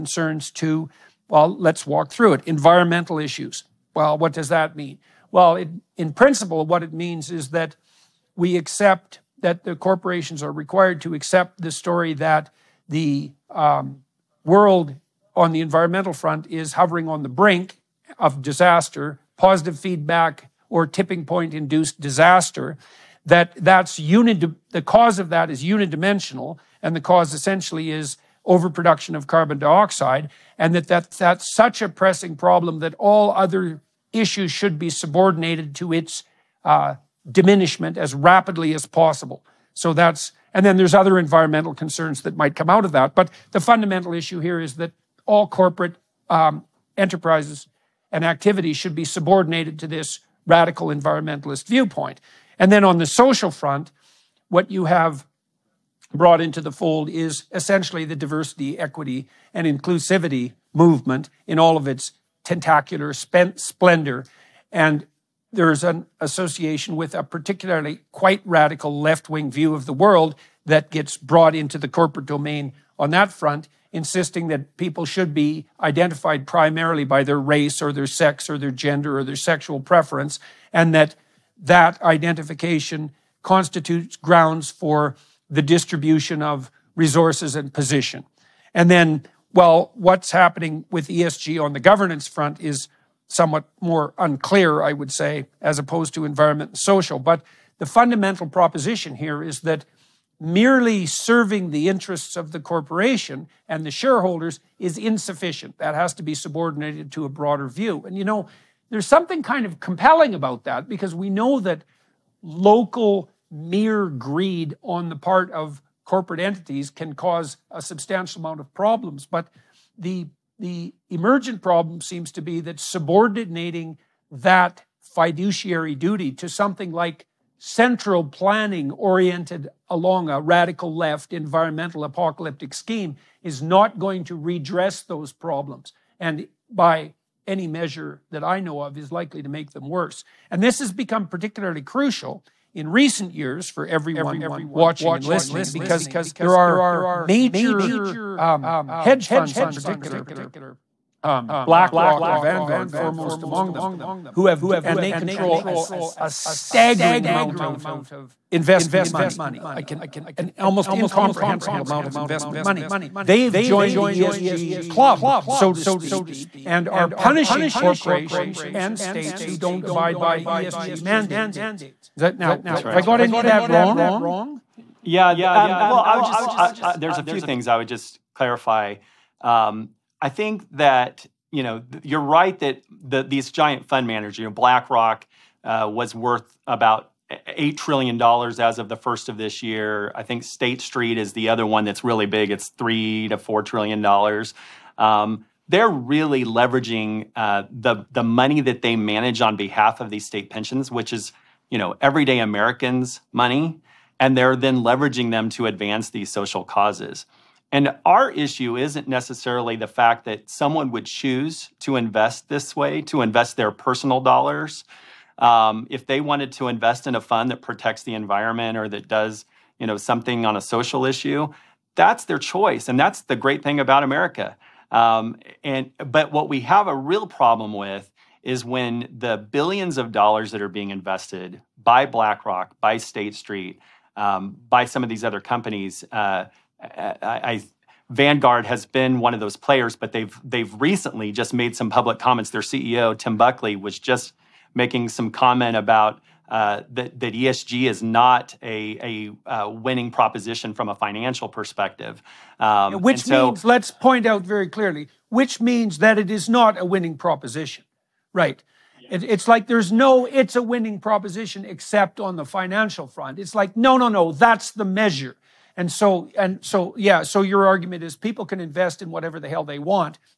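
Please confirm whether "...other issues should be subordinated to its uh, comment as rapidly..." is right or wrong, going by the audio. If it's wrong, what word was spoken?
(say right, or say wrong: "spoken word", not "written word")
wrong: "diminishment", not "comment".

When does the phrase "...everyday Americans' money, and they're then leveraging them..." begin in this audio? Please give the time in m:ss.
3:22.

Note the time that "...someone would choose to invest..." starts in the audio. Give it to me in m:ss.
3:30.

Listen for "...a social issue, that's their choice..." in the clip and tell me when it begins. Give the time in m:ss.
3:40.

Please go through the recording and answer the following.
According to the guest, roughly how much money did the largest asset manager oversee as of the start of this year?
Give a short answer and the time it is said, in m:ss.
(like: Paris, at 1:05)
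$8 trillion, at 3:07.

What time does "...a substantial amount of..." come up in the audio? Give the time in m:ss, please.
1:57.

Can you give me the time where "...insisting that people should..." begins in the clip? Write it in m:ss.
1:13.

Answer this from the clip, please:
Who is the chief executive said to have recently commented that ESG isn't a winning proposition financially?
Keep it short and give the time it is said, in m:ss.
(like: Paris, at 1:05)
Tim Buckley, at 4:03.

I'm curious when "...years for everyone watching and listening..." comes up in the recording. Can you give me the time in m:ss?
2:23.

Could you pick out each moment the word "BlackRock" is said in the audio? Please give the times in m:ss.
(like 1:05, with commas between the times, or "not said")
2:31, 3:04, 3:52.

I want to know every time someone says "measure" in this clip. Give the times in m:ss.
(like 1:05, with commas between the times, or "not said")
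2:17, 4:24.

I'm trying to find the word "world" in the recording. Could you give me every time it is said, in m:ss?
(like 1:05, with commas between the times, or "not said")
0:14, 1:09.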